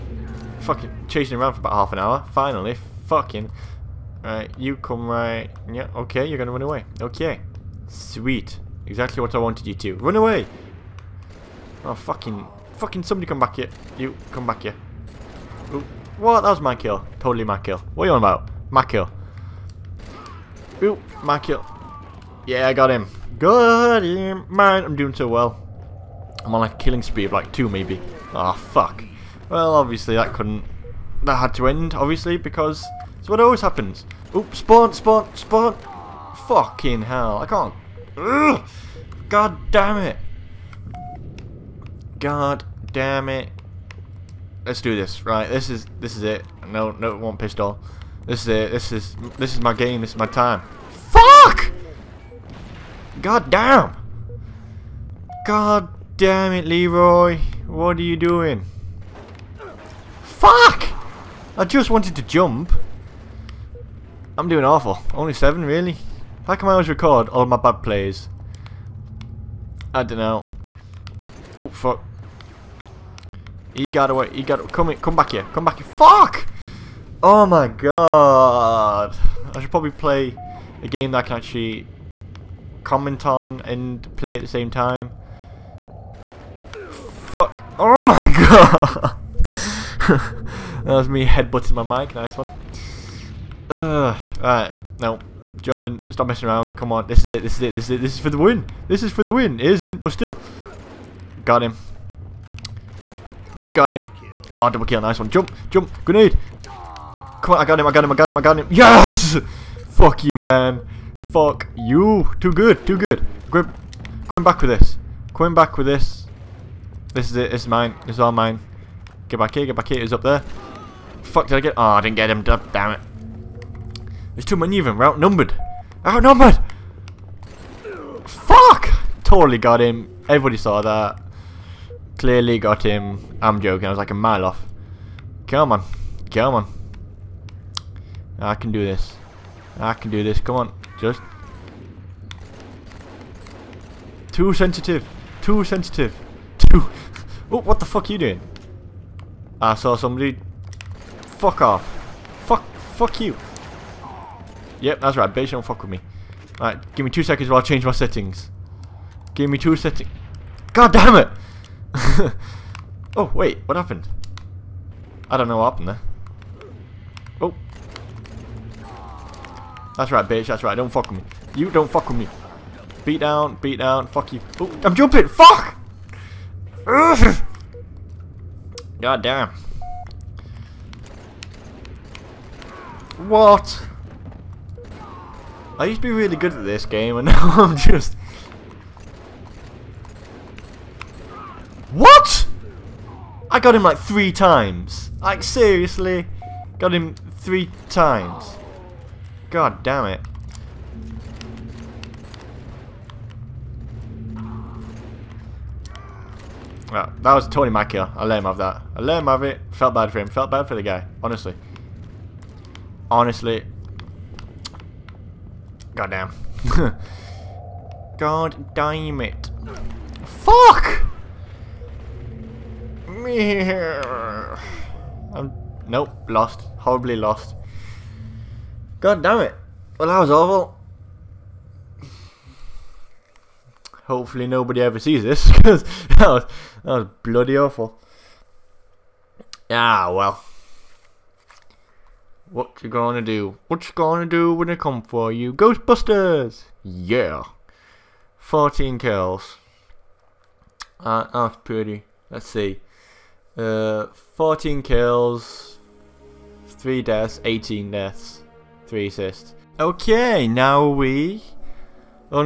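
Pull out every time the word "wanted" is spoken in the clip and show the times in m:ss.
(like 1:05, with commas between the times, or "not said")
0:09, 1:01.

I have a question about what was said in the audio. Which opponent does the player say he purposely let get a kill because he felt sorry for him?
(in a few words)
Tony Mackie.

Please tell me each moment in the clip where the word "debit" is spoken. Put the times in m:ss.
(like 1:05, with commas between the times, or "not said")
not said.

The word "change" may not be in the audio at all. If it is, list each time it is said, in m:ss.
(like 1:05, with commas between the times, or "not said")
2:37.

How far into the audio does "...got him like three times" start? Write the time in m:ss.
3:13.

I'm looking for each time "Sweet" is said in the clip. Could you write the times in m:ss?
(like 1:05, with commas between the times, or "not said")
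0:07.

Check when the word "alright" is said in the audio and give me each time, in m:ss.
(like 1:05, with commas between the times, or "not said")
1:34, 2:36.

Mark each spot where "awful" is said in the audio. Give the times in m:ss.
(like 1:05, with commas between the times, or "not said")
1:04, 3:50, 3:57.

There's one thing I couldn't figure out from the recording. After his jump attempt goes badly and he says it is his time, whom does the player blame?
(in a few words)
Leroy.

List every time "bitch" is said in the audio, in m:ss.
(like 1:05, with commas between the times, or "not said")
2:35, 2:50.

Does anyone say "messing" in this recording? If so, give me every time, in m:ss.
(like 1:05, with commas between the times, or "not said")
1:36.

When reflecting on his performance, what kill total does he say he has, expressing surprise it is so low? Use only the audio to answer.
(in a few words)
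7.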